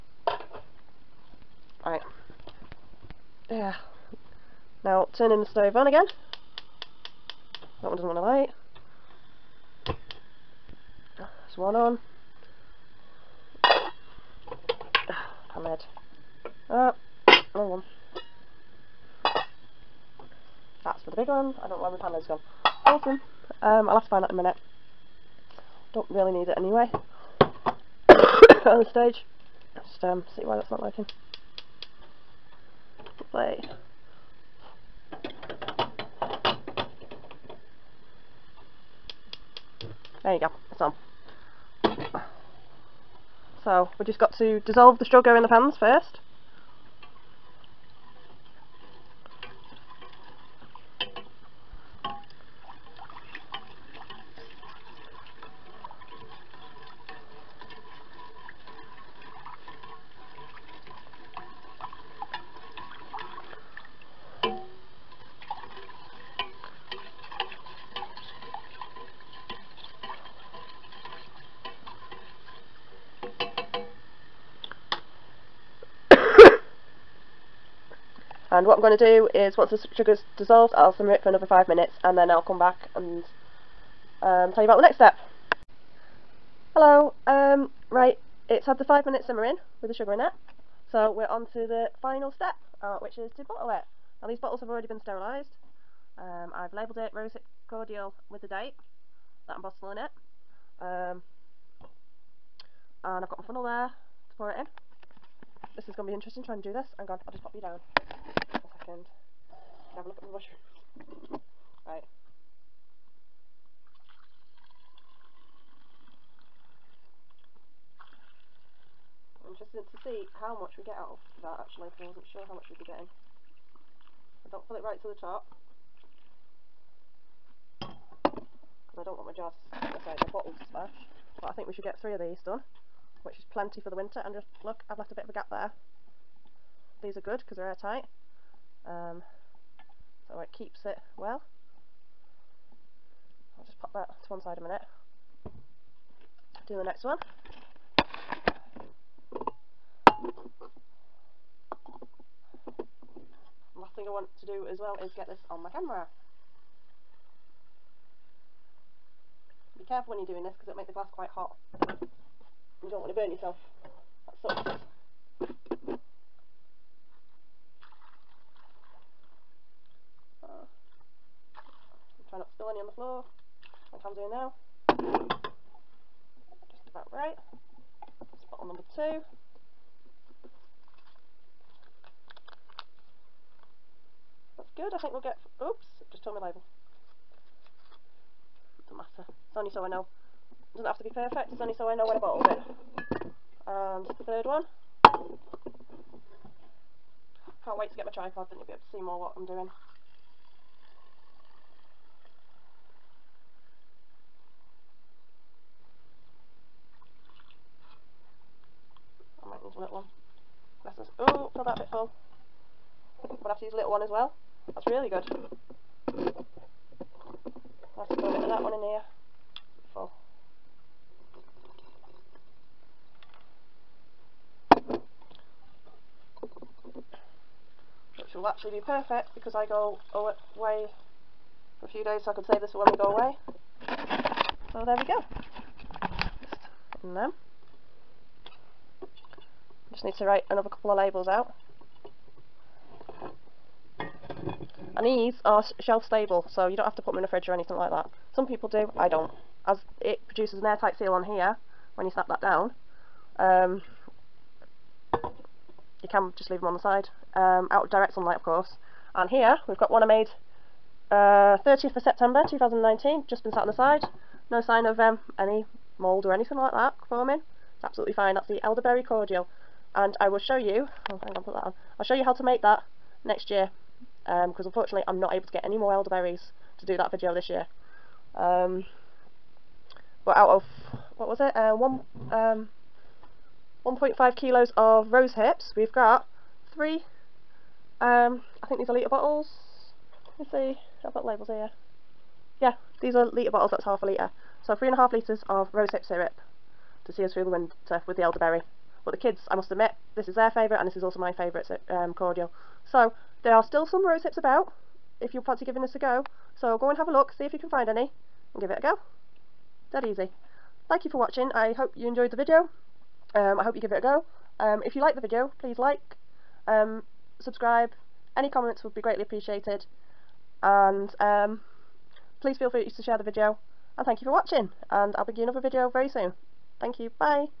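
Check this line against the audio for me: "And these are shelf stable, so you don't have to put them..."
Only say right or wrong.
right.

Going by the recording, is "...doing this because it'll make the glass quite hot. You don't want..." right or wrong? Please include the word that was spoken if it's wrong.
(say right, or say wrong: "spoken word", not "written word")
right.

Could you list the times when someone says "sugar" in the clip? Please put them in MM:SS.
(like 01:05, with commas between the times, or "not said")
00:45, 01:19, 01:29.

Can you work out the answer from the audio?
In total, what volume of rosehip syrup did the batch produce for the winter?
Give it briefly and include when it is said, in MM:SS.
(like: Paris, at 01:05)
3.5 litres, at 04:54.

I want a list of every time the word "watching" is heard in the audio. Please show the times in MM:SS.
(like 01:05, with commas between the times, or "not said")
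05:11, 05:24.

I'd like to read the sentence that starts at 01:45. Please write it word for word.
This is going to be interesting trying to do this.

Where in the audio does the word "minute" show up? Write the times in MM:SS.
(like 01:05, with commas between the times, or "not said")
00:24, 01:21, 01:29, 02:24.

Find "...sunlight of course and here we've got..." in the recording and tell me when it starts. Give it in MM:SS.
04:18.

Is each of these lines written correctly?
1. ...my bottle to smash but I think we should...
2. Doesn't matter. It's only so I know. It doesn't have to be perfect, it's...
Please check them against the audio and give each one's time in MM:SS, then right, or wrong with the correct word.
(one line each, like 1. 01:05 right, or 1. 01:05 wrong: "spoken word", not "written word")
1. 02:10 right
2. 03:08 right.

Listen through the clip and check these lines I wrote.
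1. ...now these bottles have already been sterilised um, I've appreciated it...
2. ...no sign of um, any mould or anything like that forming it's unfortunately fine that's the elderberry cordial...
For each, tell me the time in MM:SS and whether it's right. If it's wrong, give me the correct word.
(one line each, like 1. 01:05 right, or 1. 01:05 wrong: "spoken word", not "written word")
1. 01:34 wrong: "labelled", not "appreciated"
2. 04:24 wrong: "absolutely", not "unfortunately".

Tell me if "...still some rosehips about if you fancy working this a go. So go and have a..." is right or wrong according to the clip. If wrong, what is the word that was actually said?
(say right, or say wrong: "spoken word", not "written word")
wrong: "giving", not "working".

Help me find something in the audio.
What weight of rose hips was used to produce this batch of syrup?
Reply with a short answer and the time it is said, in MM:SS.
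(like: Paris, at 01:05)
1.5 kilos, at 04:43.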